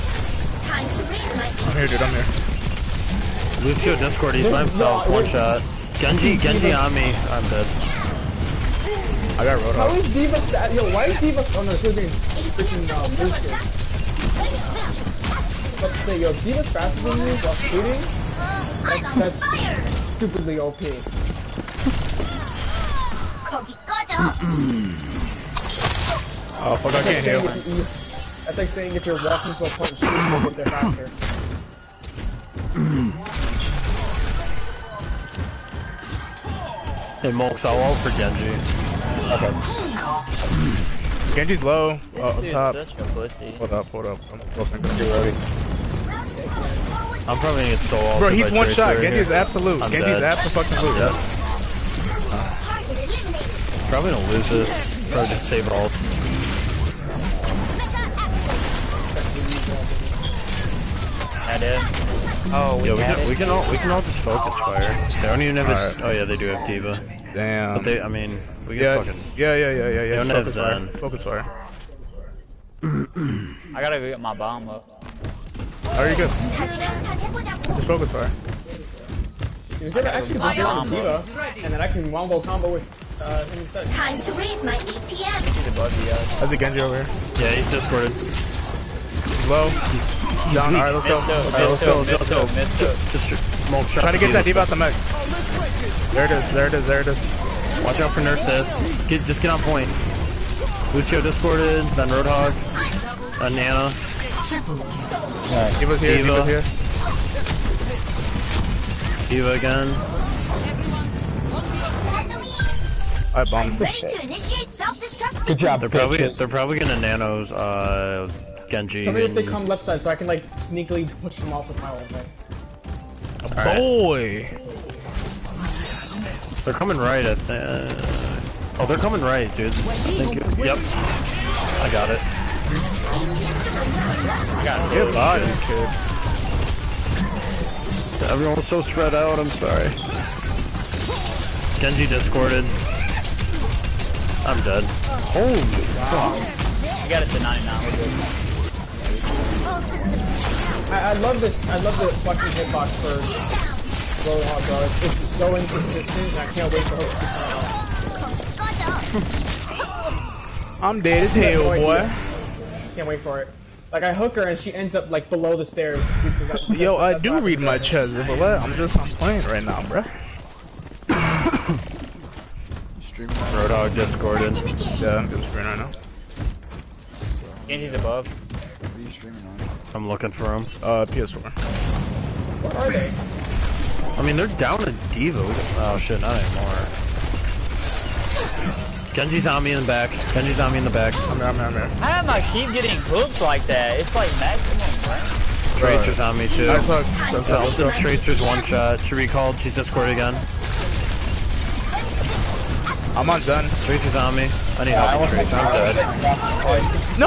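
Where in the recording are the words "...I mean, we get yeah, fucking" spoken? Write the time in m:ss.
1:08.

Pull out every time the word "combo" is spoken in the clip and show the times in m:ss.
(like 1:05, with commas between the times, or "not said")
1:22.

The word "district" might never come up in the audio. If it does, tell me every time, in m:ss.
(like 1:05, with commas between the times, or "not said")
not said.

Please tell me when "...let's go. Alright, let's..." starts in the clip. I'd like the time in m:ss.
1:30.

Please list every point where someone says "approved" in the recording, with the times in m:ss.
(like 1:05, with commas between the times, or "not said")
not said.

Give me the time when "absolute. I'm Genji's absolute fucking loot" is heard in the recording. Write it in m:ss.
0:49.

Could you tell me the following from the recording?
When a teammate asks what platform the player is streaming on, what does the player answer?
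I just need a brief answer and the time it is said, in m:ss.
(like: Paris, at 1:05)
PS4, at 3:01.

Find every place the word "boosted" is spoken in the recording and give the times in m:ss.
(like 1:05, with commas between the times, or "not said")
0:13.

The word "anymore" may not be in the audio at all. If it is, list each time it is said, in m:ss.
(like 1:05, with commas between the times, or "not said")
3:06.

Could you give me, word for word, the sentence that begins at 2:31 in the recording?
I love the fucking hitbox for really hard, bro.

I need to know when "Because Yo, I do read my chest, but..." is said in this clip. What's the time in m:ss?
2:46.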